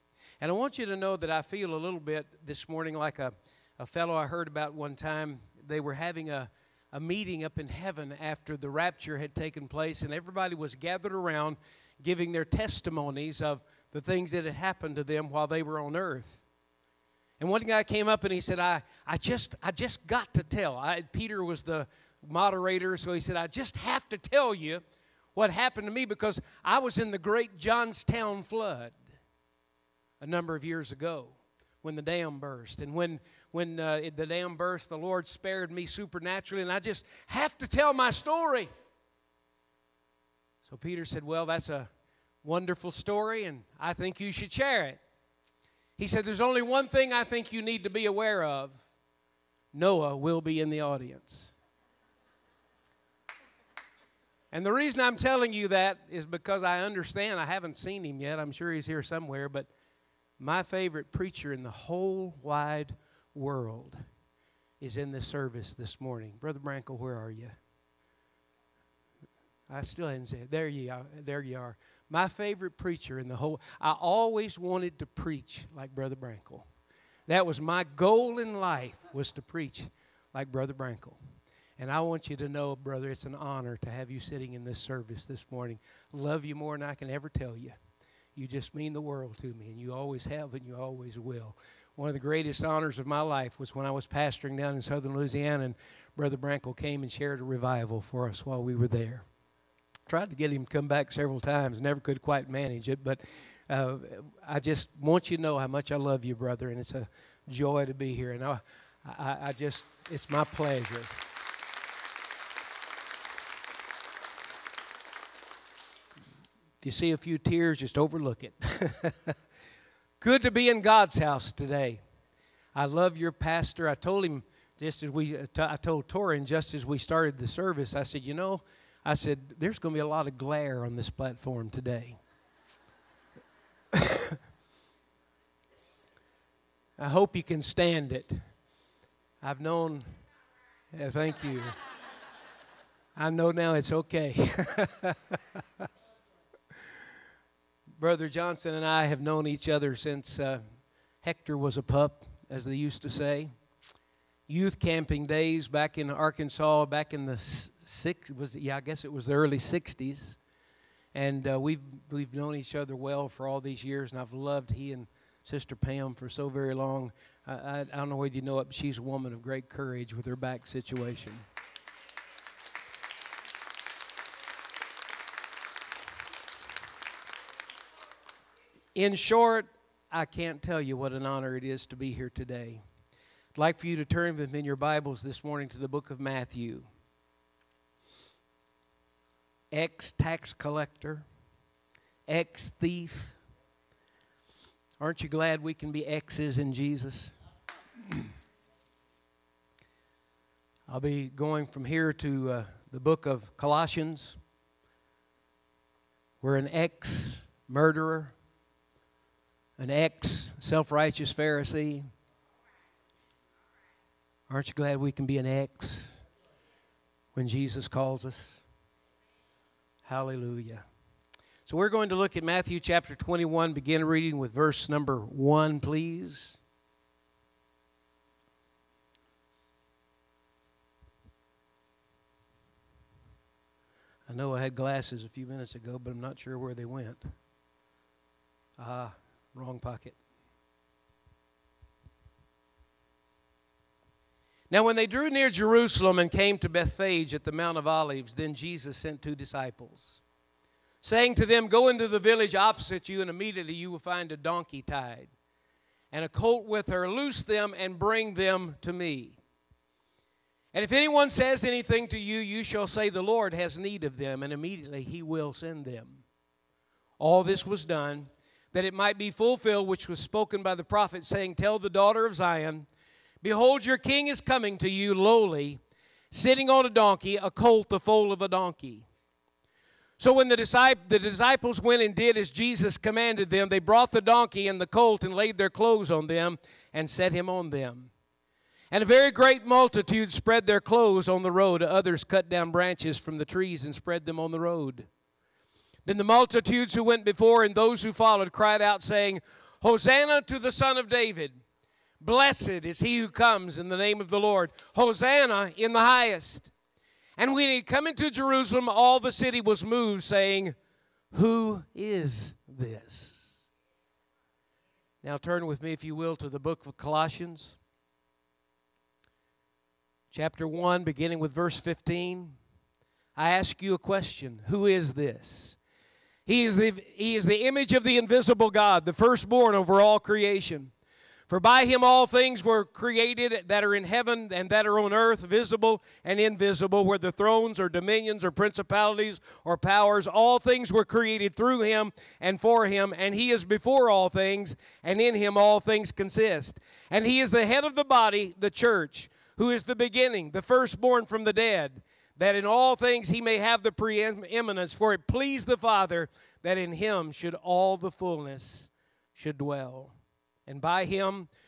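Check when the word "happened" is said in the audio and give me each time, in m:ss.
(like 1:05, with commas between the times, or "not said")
0:14, 0:25.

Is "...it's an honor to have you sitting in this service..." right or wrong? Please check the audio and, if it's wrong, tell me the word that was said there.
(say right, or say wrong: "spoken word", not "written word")
right.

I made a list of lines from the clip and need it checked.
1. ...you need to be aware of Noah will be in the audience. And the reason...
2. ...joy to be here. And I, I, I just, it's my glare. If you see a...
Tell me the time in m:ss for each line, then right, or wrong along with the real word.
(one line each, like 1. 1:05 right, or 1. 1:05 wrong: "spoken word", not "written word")
1. 0:47 right
2. 1:47 wrong: "pleasure", not "glare".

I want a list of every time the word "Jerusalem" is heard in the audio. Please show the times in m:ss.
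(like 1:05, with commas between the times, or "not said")
4:05, 5:08.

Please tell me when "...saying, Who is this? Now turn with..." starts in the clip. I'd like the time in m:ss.
5:10.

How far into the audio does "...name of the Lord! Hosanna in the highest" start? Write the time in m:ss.
5:03.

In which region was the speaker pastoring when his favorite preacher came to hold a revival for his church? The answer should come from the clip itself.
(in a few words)
southern Louisiana.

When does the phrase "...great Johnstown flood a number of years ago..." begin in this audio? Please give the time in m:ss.
0:27.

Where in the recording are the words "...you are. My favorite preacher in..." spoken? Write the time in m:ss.
1:11.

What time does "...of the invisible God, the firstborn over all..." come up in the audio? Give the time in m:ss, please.
5:27.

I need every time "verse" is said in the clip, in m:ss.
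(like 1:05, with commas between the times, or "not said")
3:44, 5:21.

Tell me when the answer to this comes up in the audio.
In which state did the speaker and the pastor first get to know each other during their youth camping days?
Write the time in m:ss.
2:36.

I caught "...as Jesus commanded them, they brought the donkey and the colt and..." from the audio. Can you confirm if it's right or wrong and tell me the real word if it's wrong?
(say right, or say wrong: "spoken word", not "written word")
right.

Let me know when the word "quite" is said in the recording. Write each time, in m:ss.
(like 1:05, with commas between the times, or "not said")
1:42.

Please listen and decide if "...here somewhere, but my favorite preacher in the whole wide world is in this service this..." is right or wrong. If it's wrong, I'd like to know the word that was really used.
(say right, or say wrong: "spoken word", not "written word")
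right.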